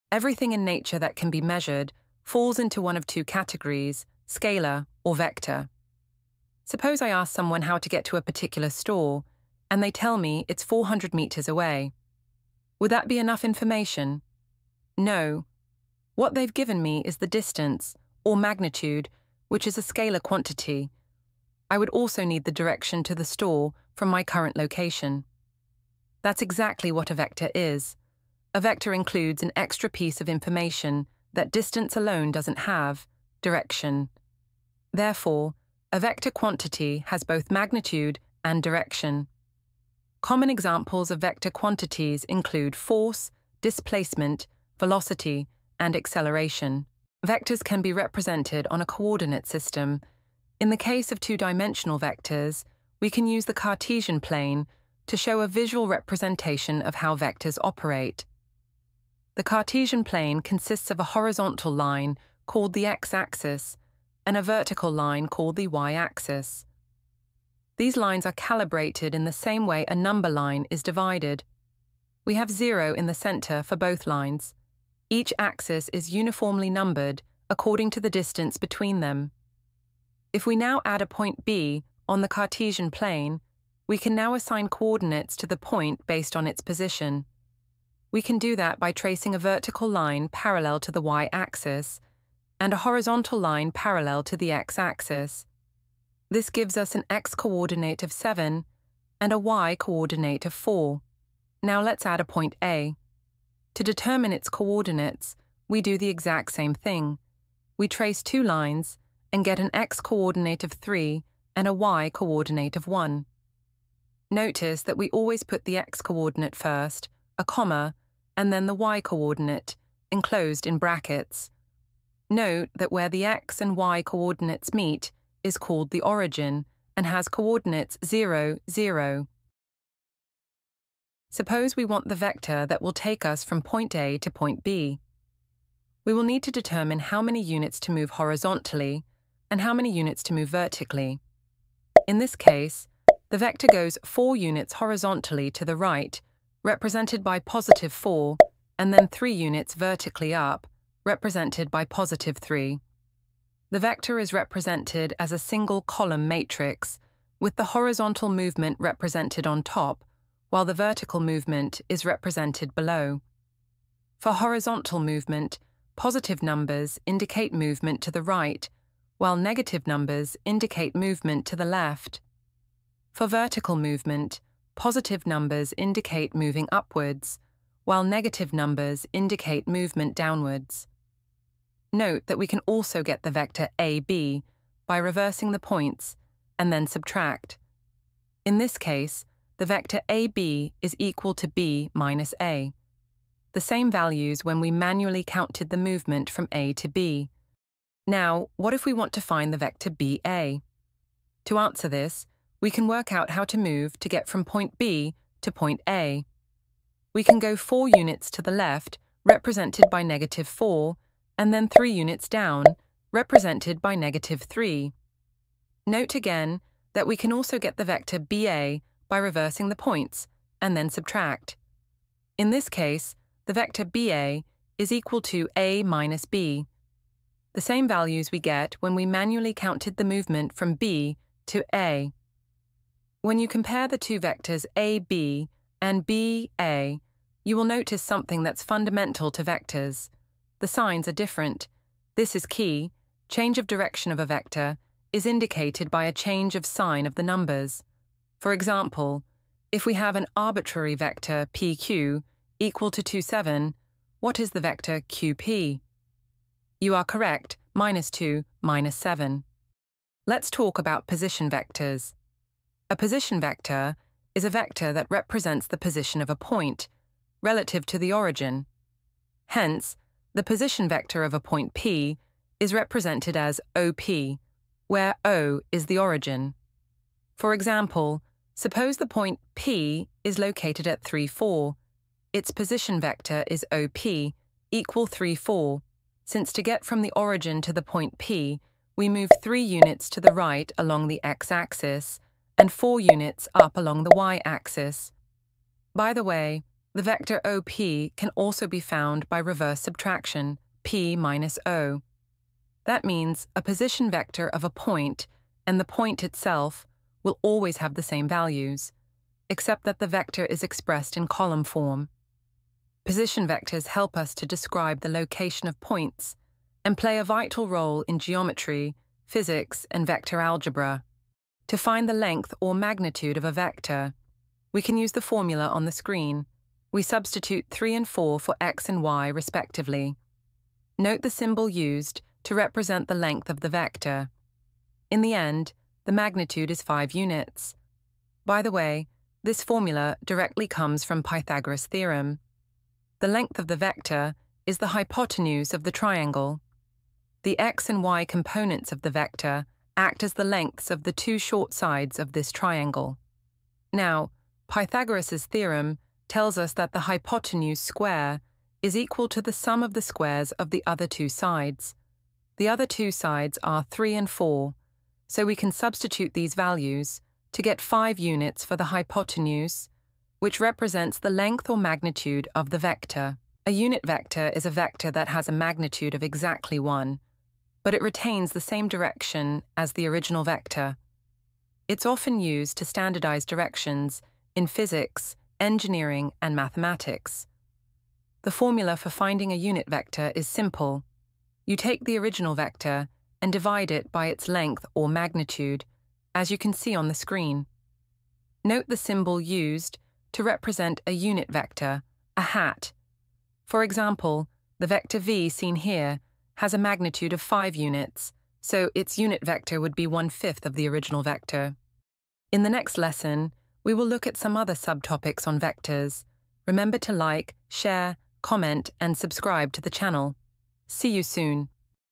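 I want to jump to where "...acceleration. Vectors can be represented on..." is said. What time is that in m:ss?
0:45.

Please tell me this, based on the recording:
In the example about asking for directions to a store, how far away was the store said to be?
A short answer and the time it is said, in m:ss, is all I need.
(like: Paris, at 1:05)
400 meters, at 0:10.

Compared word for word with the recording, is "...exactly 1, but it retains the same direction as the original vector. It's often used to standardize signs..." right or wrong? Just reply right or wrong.
wrong.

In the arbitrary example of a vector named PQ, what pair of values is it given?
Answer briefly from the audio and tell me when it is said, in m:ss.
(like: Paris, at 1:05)
2, 7, at 4:13.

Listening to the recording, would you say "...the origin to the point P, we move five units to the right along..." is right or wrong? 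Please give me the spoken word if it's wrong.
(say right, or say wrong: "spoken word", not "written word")
wrong: "three", not "five".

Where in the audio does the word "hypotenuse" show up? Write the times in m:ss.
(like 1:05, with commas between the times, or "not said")
5:44, 5:57, 6:08.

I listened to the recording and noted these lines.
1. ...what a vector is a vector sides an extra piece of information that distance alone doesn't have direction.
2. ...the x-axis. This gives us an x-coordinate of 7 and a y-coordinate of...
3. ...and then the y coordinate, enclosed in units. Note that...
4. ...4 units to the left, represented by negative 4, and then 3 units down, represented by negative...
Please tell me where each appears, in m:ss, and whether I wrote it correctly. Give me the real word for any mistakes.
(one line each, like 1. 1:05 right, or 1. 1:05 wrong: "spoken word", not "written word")
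1. 0:26 wrong: "includes", not "sides"
2. 1:34 right
3. 1:58 wrong: "brackets", not "units"
4. 3:27 right.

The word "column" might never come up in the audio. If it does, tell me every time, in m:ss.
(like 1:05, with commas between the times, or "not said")
2:35, 5:11.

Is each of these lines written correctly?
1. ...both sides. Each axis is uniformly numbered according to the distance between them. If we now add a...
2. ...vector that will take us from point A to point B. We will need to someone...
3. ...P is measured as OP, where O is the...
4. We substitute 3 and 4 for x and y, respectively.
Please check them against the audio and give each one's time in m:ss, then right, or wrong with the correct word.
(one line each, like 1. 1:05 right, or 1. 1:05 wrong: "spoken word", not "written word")
1. 1:13 wrong: "lines", not "sides"
2. 2:12 wrong: "determine", not "someone"
3. 4:31 wrong: "represented", not "measured"
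4. 5:26 right.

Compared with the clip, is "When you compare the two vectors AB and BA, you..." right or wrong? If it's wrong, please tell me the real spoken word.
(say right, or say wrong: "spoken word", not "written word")
right.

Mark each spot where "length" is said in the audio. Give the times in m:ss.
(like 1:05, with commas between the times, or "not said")
5:22, 5:33, 5:43, 5:50, 6:11, 6:34.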